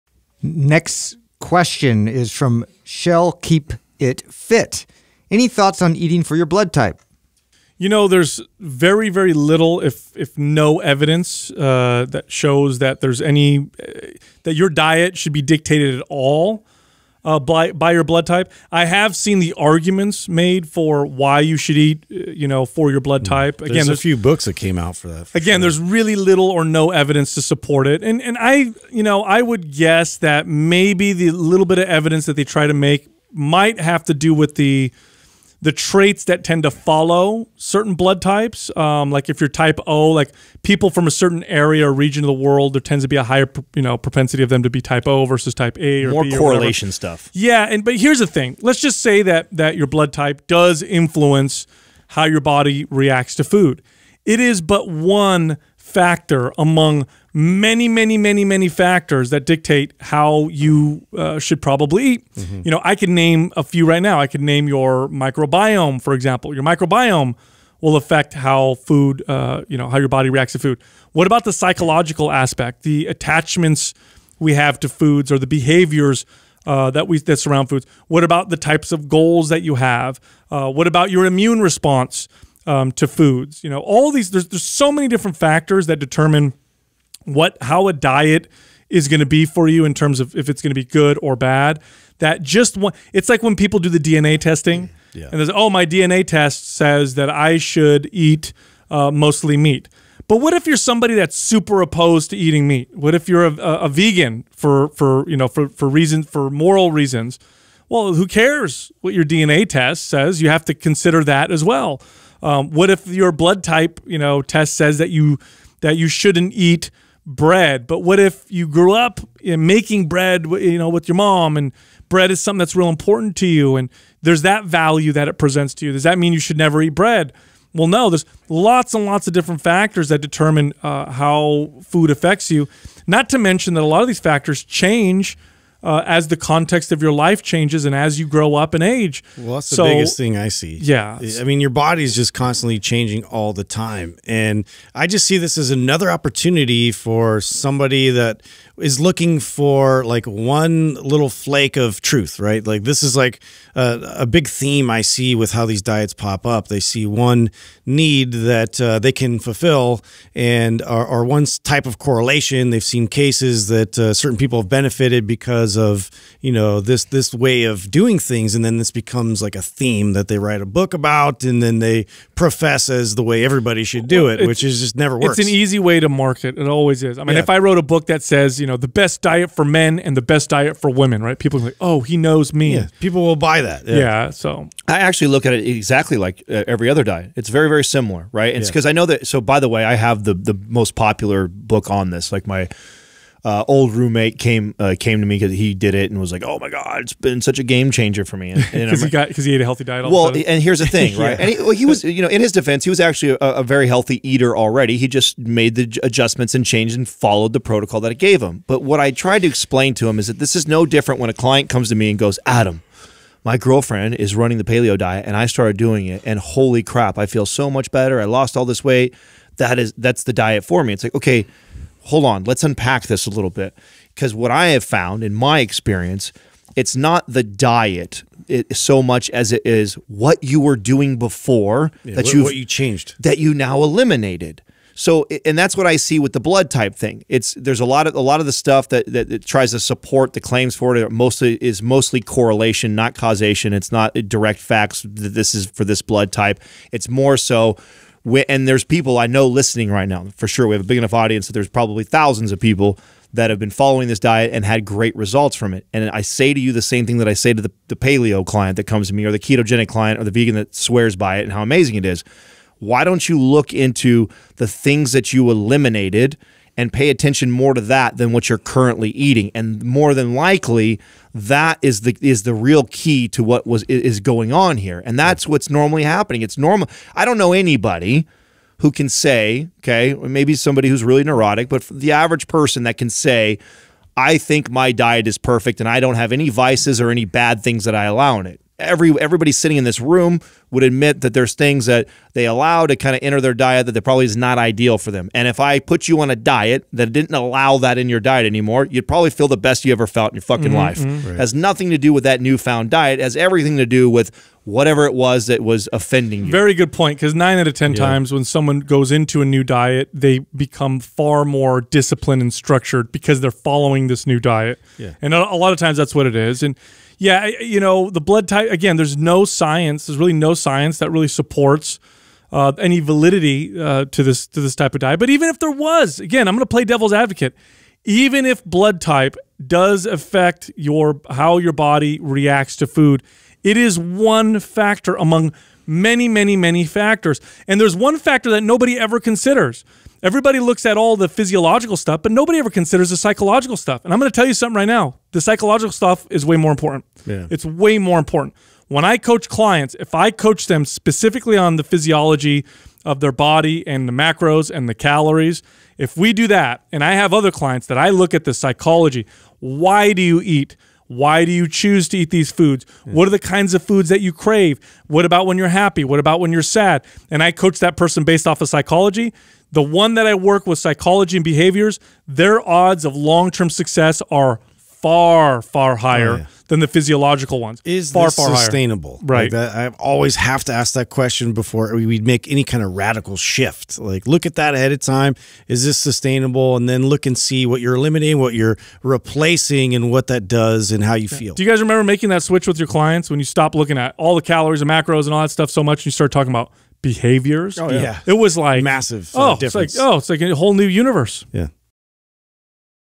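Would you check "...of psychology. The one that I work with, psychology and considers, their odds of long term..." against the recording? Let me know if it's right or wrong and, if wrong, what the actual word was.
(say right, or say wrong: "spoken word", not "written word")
wrong: "behaviors", not "considers".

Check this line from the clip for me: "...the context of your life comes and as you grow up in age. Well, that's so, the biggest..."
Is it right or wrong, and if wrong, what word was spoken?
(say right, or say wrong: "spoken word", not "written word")
wrong: "changes", not "comes".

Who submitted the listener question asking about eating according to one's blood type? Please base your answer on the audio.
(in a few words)
Shell Keep It Fit.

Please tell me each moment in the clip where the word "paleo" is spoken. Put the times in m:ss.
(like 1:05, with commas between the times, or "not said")
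3:34, 4:17.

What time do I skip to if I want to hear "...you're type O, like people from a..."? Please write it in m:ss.
0:39.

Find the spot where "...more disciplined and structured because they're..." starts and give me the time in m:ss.
5:11.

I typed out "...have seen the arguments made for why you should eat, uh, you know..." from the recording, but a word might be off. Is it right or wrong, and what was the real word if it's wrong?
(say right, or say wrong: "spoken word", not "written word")
right.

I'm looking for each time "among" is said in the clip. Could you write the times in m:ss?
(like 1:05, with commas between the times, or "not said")
0:56, 5:35.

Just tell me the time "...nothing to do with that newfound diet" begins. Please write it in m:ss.
5:01.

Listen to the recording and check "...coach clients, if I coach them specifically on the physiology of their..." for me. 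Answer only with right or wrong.
right.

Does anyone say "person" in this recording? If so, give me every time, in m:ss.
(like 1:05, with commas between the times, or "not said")
4:42, 6:07.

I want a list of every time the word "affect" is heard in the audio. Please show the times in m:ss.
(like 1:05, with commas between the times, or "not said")
1:07, 2:12, 5:30.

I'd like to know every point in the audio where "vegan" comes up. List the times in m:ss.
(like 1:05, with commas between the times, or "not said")
1:43, 4:20.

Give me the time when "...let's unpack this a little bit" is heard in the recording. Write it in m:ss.
3:42.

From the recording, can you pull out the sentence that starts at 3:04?
So I actually look at it exactly like uh, every other diet.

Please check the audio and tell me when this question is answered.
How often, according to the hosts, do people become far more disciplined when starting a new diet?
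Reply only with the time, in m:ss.
5:07.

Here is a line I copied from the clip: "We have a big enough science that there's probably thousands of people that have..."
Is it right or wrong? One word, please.
wrong.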